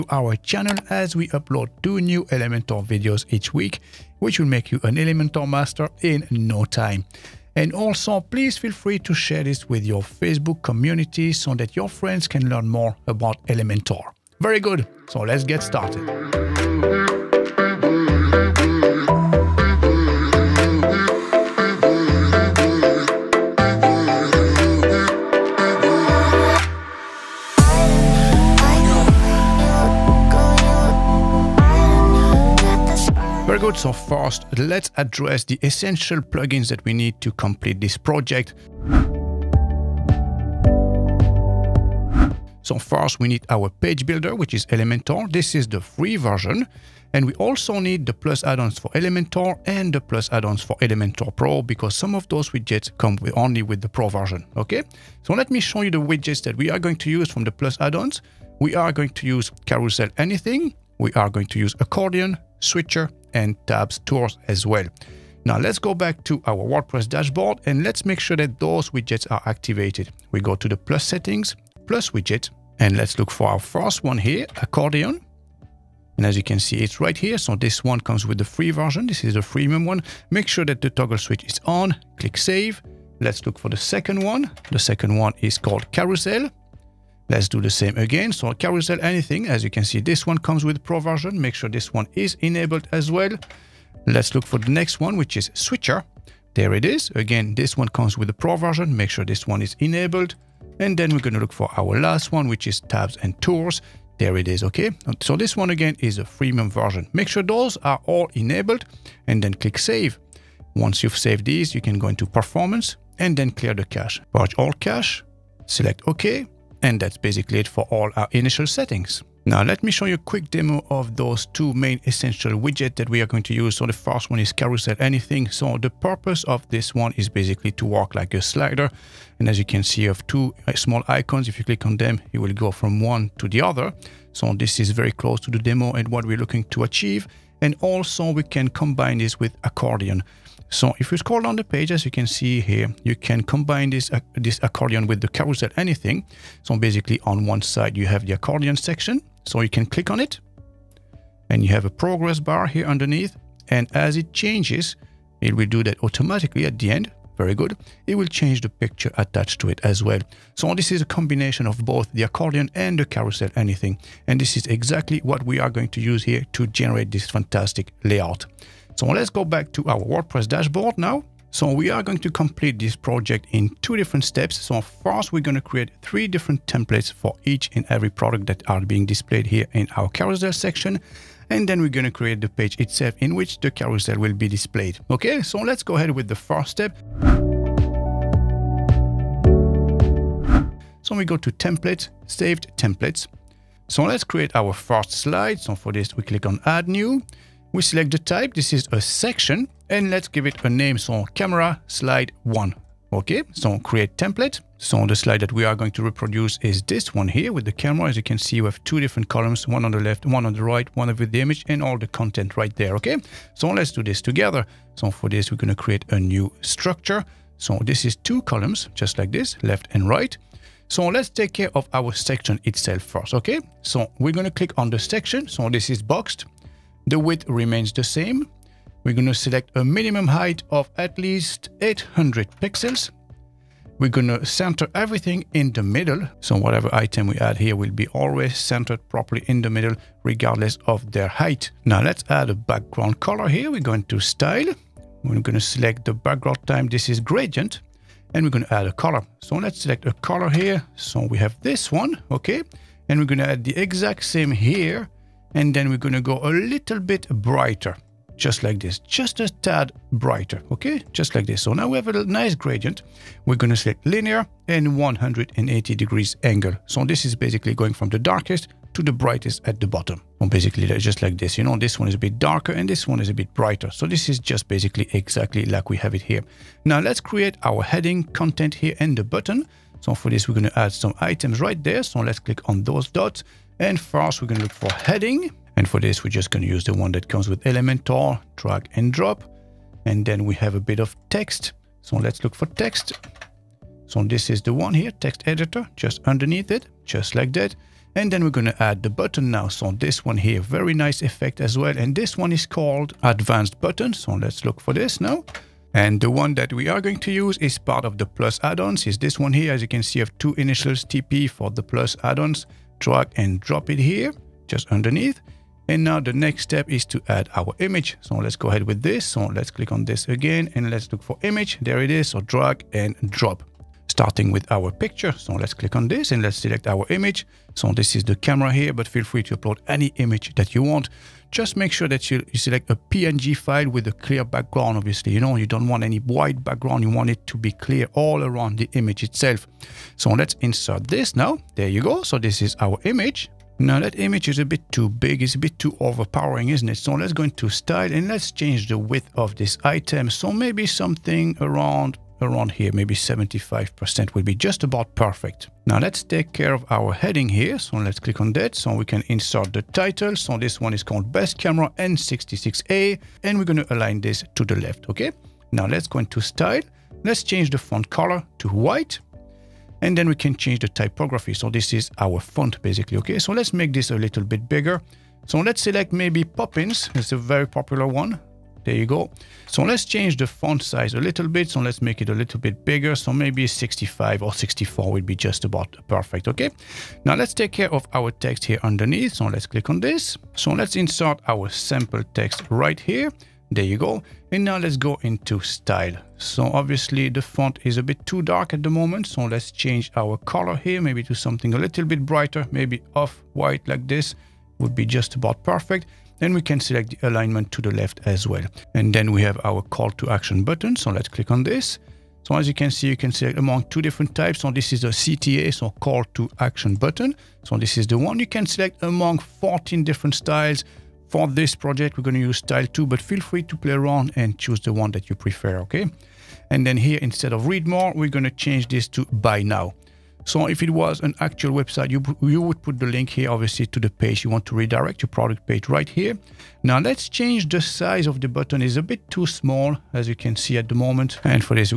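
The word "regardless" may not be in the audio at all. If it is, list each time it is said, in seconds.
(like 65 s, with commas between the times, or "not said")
240 s.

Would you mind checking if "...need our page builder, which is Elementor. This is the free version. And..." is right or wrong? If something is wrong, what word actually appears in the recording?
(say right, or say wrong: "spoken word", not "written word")
right.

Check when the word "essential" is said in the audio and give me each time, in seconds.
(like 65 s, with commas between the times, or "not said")
35 s, 122 s.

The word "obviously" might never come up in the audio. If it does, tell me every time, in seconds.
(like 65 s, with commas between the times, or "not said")
334 s, 396 s, 433 s.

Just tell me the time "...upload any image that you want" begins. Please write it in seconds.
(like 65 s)
329 s.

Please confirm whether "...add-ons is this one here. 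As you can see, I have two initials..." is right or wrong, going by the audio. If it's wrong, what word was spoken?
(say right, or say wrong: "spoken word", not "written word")
right.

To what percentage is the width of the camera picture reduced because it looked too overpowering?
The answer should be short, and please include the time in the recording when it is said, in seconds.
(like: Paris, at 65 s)
75%, at 353 s.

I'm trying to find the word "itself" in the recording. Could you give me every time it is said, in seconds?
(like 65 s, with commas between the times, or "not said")
182 s, 222 s, 339 s.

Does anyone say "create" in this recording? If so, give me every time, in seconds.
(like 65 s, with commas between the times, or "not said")
175 s, 182 s, 194 s, 203 s, 215 s, 277 s.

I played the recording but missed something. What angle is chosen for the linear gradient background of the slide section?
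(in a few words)
180 degrees.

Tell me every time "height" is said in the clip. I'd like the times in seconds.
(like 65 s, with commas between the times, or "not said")
230 s, 241 s.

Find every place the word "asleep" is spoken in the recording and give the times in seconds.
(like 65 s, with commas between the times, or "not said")
not said.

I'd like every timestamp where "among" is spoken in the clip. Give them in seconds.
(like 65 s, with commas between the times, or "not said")
413 s, 419 s.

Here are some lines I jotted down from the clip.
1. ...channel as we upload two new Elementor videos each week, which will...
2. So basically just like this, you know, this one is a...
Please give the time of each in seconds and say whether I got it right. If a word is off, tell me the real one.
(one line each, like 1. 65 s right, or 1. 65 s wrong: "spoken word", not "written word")
1. 0 s right
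2. 270 s right.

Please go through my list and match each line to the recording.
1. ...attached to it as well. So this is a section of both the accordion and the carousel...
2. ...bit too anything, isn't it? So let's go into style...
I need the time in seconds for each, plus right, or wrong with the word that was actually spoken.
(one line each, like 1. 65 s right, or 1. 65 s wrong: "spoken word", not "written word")
1. 159 s wrong: "combination", not "section"
2. 345 s wrong: "overpowering", not "anything".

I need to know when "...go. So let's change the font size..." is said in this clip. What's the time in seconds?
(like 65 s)
379 s.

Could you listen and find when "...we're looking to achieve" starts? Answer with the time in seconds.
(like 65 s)
136 s.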